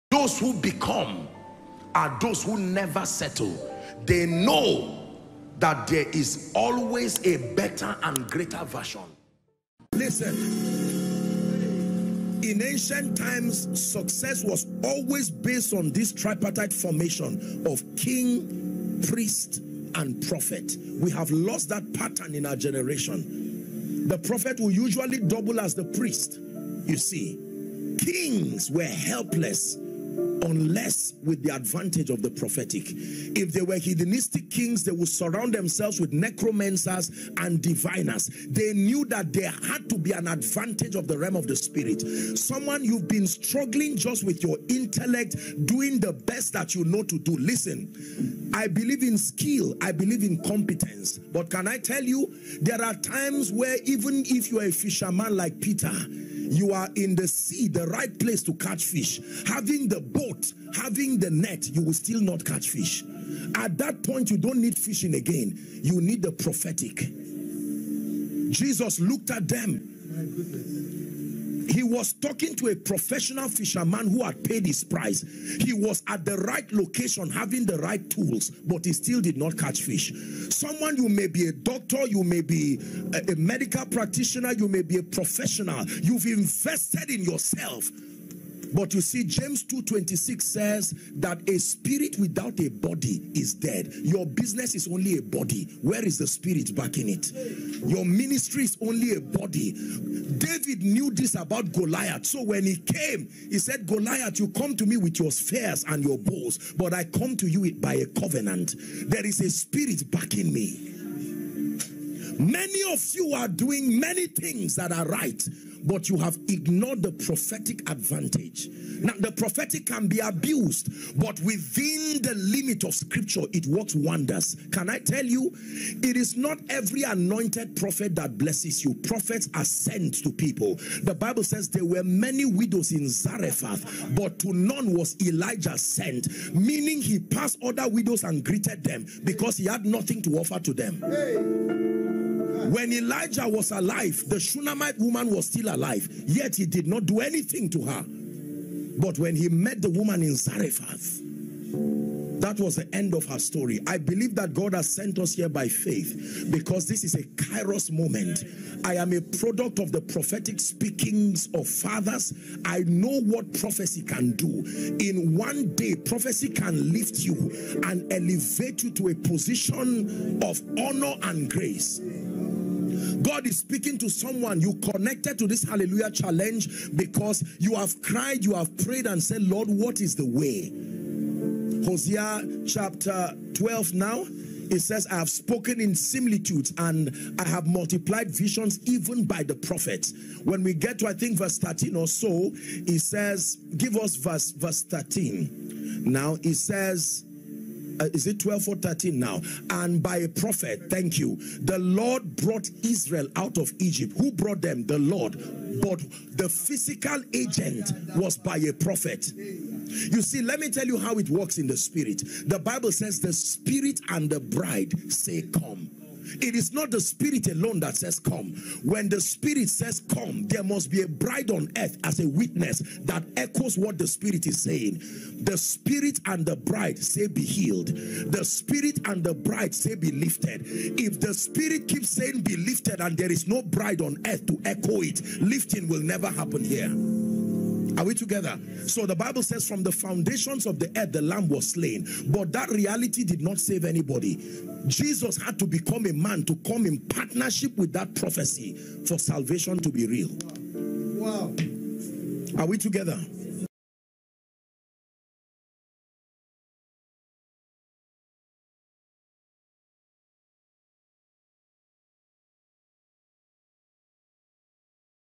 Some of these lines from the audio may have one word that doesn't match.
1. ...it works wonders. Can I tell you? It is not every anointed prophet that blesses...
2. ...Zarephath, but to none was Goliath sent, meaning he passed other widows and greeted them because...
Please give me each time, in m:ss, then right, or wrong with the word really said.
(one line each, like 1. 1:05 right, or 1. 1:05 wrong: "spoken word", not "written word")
1. 2:03 right
2. 2:13 wrong: "Elijah", not "Goliath".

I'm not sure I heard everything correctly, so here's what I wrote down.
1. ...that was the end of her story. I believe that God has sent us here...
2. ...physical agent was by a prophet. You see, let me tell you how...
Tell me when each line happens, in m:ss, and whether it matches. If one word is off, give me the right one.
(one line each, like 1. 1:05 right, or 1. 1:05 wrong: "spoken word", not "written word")
1. 2:32 right
2. 3:26 right.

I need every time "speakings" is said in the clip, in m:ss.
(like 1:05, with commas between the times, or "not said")
2:40, 2:53.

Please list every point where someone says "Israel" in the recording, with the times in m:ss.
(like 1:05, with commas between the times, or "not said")
3:22.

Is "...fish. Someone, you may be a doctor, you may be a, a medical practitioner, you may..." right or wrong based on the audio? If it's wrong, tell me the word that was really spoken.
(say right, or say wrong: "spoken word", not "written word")
right.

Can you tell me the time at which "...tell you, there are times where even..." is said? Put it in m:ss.
0:51.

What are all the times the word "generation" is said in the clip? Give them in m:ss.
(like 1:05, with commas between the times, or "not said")
0:22.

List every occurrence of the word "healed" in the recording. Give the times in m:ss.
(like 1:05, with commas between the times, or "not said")
3:47.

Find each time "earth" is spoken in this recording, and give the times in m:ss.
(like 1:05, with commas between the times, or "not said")
3:41, 3:54, 4:00.